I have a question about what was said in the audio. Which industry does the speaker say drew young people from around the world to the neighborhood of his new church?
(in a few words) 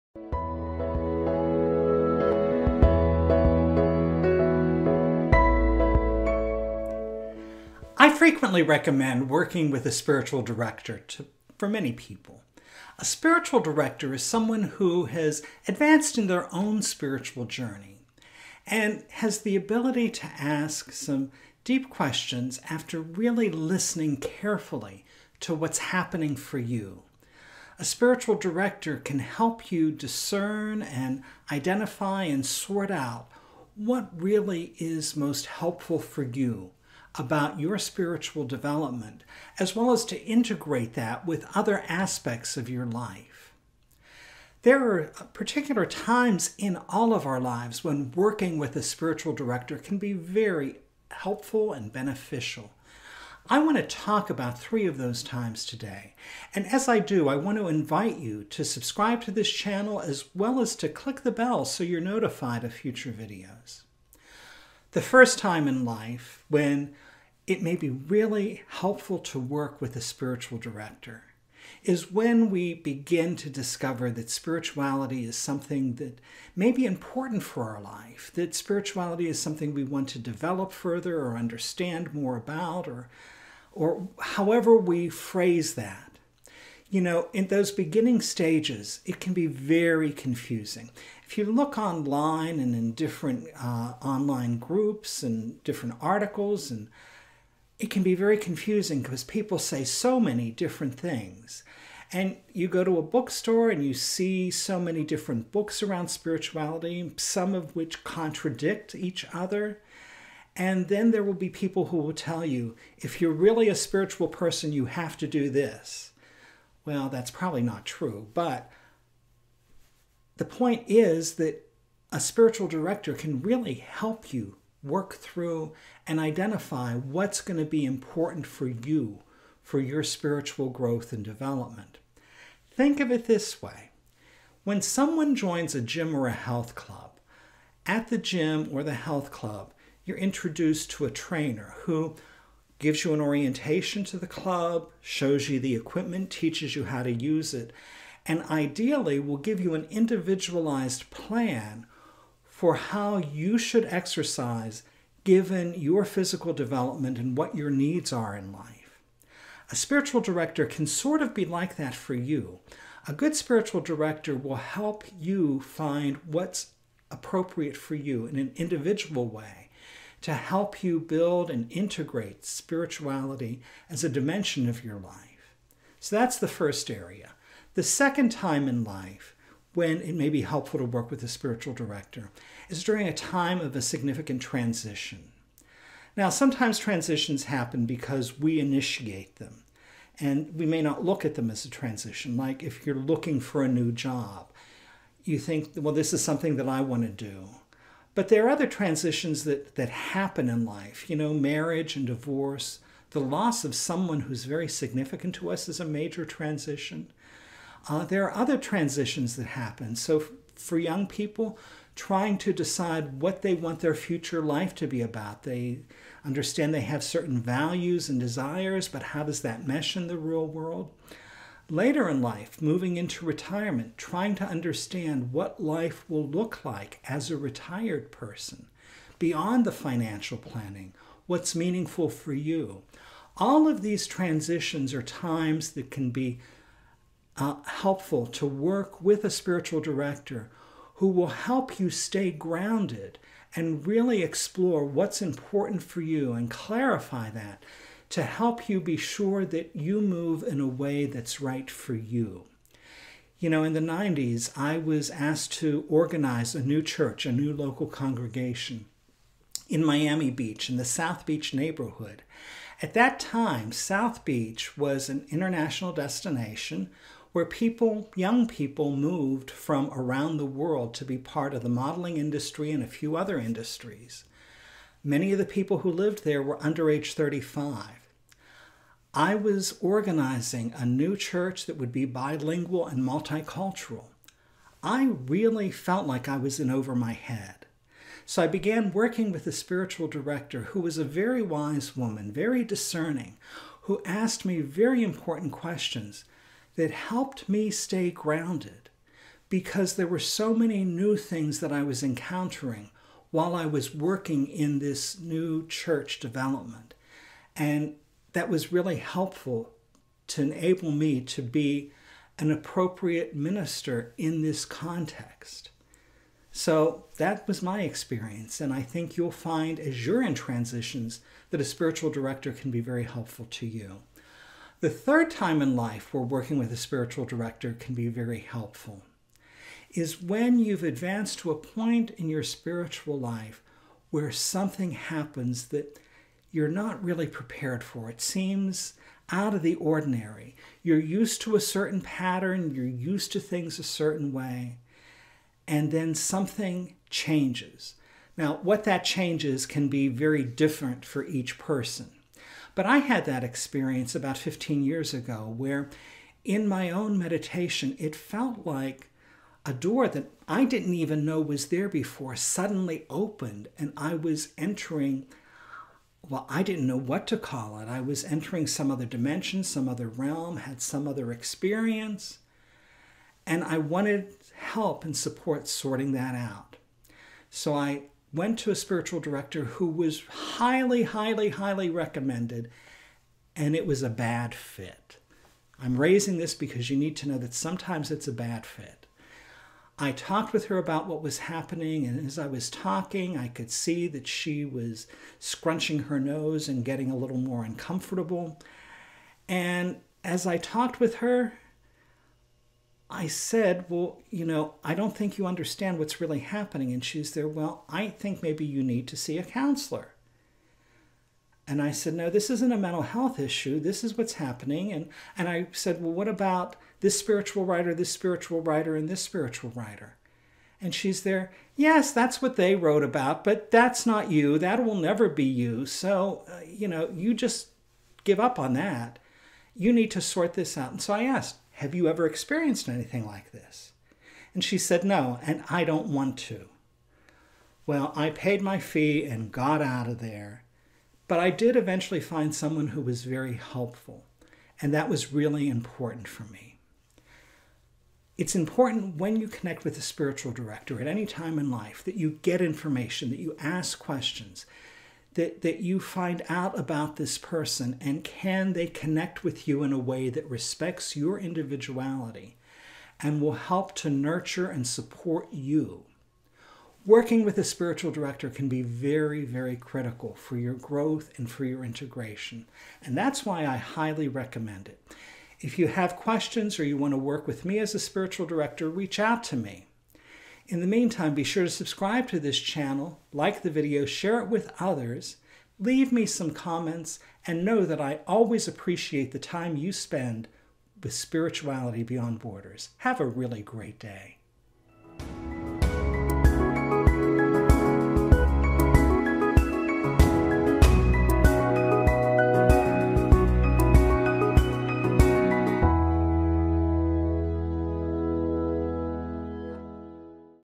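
modeling industry.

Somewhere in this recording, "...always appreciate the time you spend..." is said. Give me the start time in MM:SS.
08:08.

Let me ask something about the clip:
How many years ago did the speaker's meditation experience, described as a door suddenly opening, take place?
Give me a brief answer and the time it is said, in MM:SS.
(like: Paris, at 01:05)
15, at 05:54.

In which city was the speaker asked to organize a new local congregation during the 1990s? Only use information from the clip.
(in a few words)
Miami Beach.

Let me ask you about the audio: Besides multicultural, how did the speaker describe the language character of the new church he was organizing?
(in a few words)
bilingual.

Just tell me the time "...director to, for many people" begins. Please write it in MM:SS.
00:10.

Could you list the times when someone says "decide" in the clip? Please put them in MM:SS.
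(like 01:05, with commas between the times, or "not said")
03:32.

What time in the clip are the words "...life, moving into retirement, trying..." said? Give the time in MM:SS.
03:42.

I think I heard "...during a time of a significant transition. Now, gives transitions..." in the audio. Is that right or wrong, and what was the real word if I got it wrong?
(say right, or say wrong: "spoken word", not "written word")
wrong: "sometimes", not "gives".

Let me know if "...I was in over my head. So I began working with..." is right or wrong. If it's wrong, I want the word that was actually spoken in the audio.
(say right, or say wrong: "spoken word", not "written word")
right.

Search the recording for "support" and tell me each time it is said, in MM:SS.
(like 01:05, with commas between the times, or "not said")
06:15, 07:44.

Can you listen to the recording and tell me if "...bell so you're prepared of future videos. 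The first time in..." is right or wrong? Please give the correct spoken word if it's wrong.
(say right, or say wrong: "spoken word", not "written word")
wrong: "notified", not "prepared".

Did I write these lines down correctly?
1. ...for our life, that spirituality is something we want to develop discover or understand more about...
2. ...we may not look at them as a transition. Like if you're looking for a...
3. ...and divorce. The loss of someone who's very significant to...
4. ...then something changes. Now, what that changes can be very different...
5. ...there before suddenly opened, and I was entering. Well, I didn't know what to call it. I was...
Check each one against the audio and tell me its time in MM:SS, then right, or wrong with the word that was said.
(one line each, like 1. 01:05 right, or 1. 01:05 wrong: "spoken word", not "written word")
1. 01:17 wrong: "further", not "discover"
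2. 03:10 right
3. 03:21 right
4. 05:45 right
5. 06:01 right.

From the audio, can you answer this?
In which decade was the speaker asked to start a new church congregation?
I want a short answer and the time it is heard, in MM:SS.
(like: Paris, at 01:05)
the 90s, at 04:13.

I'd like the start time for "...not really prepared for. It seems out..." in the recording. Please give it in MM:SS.
05:36.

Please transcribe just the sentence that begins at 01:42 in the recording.
And you go to a bookstore and you see so many different books around spirituality, some of which contradict each other.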